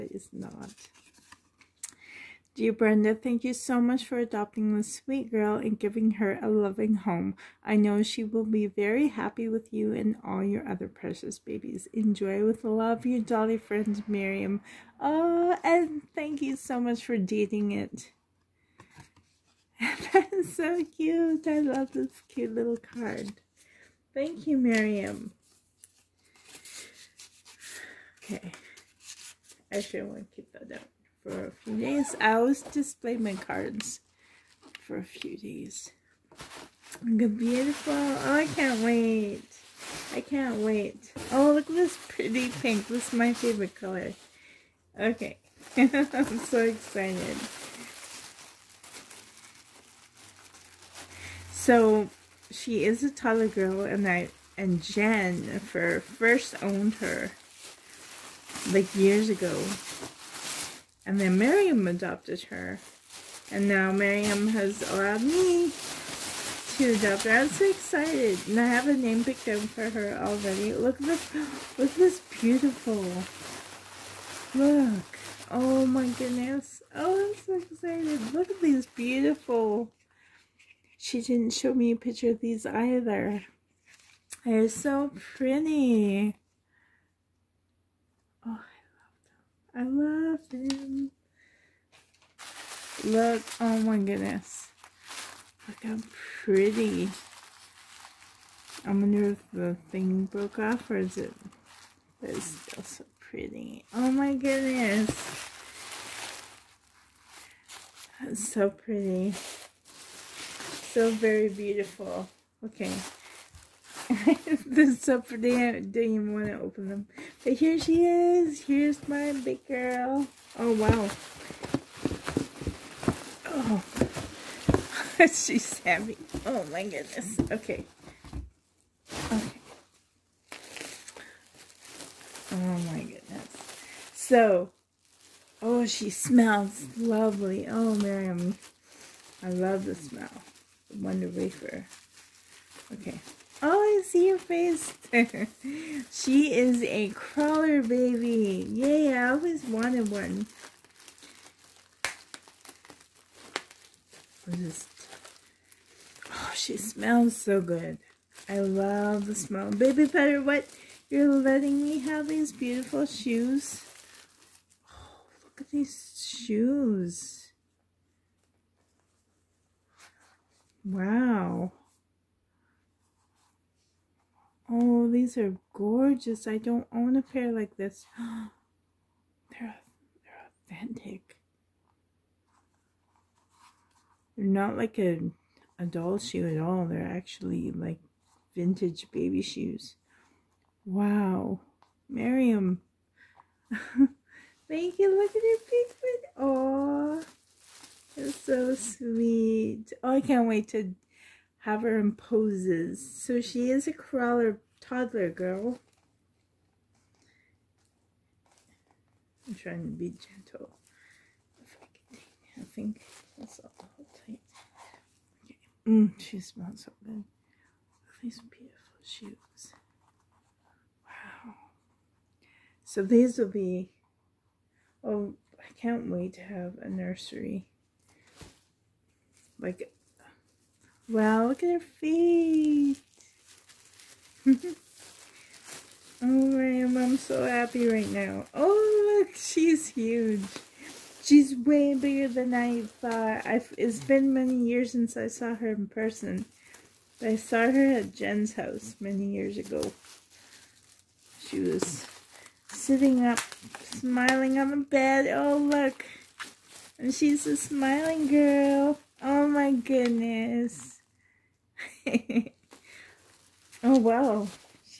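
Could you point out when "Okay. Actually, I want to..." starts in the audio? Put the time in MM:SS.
00:28.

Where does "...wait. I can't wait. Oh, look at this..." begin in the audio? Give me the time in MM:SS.
00:38.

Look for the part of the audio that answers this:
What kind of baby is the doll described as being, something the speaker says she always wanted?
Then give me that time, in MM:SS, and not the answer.
02:27.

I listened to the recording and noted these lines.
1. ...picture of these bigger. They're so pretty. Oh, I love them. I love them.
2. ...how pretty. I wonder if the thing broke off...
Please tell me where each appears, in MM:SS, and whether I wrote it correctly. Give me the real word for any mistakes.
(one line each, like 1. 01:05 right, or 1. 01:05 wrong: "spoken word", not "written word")
1. 01:21 wrong: "either", not "bigger"
2. 01:35 right.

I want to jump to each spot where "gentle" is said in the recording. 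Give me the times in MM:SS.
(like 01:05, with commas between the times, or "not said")
03:30.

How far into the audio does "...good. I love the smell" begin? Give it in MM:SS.
02:37.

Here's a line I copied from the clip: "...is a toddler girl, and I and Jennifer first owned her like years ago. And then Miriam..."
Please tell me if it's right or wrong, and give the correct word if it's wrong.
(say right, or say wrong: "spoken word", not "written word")
right.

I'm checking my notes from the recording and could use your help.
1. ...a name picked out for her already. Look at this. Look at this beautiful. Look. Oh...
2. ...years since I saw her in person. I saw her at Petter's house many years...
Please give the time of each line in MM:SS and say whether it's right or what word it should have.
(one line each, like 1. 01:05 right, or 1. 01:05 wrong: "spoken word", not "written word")
1. 01:08 right
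2. 04:04 wrong: "Jen", not "Petter".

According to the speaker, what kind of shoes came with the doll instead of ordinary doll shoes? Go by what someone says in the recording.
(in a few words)
Vintage baby shoes.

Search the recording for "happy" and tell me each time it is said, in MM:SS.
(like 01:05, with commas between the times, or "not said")
00:09, 03:57.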